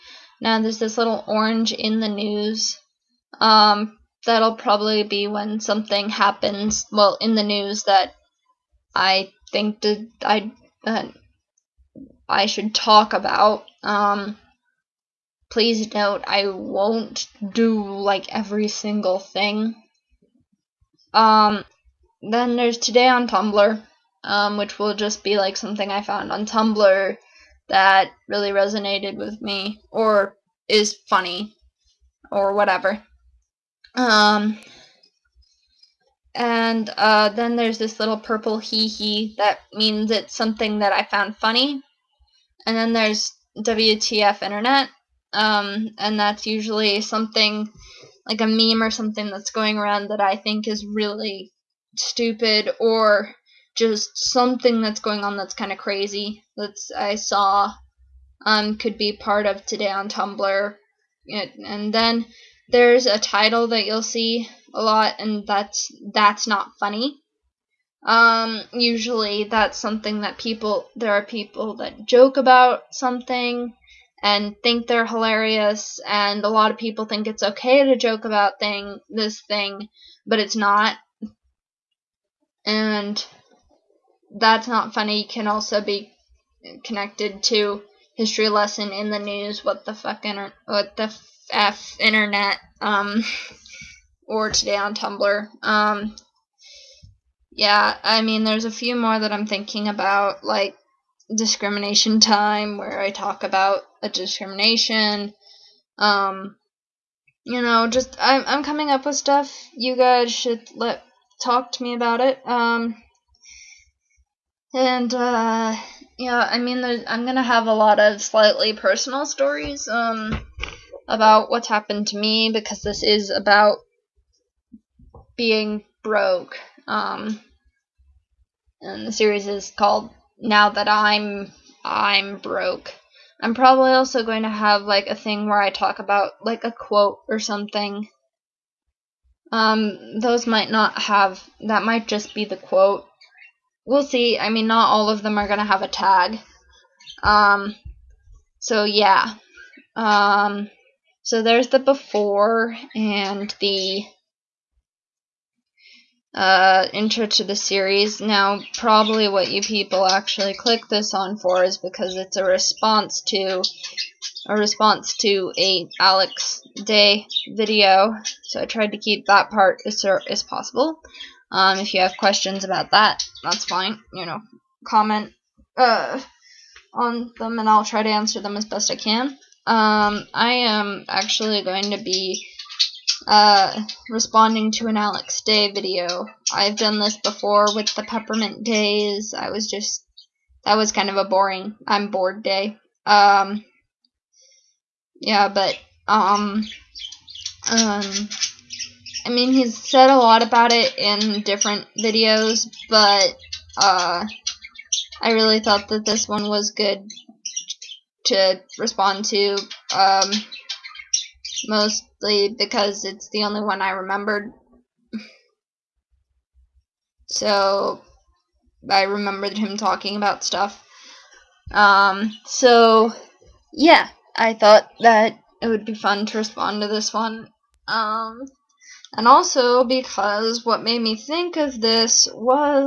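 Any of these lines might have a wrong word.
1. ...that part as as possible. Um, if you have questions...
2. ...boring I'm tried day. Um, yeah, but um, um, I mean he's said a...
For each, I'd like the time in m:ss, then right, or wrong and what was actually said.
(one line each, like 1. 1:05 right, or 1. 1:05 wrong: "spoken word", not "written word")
1. 2:49 right
2. 3:11 wrong: "bored", not "tried".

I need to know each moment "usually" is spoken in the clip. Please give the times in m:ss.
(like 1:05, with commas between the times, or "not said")
0:46, 1:08.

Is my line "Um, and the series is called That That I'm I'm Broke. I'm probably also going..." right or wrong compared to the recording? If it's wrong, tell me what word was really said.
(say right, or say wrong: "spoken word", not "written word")
wrong: "Now", not "That".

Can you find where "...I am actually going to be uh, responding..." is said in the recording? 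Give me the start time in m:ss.
3:00.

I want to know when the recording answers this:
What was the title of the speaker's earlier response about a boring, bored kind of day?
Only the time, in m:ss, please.
3:08.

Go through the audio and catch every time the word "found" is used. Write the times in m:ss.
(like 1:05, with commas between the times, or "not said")
0:26, 0:41.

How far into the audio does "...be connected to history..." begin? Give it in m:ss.
1:25.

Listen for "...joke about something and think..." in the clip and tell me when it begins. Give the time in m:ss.
1:12.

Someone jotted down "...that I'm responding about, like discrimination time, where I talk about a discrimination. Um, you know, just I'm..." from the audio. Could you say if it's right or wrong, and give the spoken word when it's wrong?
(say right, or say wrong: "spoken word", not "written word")
wrong: "thinking", not "responding".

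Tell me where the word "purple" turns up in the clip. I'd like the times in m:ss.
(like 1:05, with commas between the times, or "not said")
0:38.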